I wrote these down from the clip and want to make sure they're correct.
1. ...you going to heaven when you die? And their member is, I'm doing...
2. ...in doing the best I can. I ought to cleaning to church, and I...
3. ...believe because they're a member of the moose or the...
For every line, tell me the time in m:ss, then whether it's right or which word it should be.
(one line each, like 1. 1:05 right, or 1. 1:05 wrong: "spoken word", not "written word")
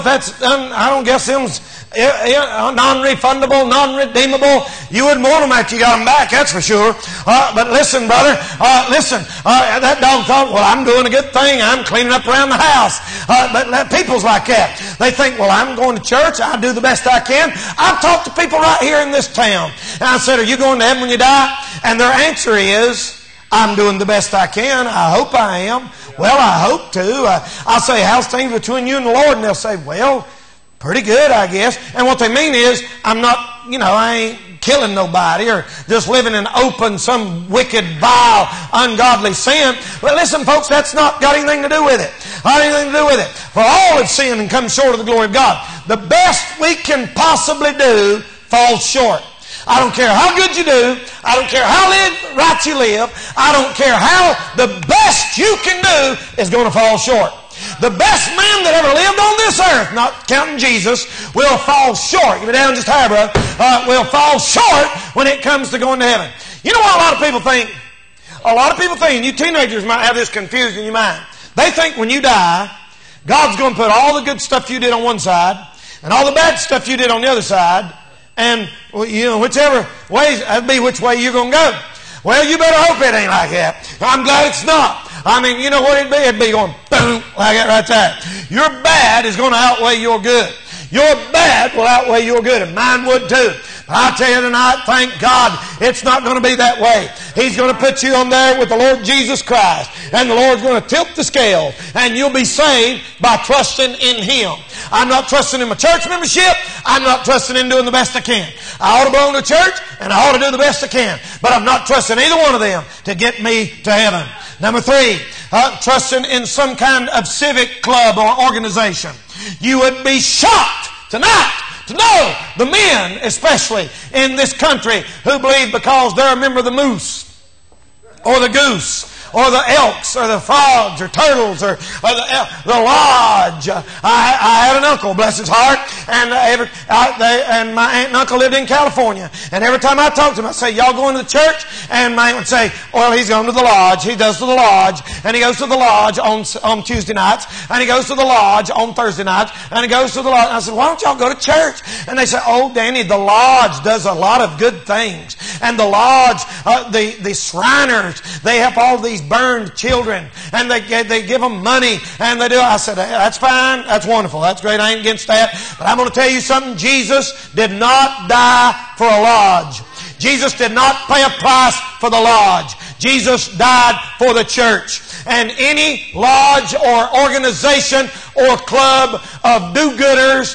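1. 0:20 wrong: "answer", not "member"
2. 1:47 wrong: "belong", not "cleaning"
3. 2:05 right.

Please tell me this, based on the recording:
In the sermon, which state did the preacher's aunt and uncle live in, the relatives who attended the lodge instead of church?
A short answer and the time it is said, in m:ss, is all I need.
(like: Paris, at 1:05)
California, at 2:18.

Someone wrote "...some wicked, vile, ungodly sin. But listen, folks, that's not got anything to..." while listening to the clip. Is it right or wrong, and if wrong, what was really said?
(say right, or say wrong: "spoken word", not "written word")
right.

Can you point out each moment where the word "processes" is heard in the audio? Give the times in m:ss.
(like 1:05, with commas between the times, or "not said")
not said.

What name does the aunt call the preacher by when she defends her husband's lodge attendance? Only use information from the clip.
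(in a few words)
Danny.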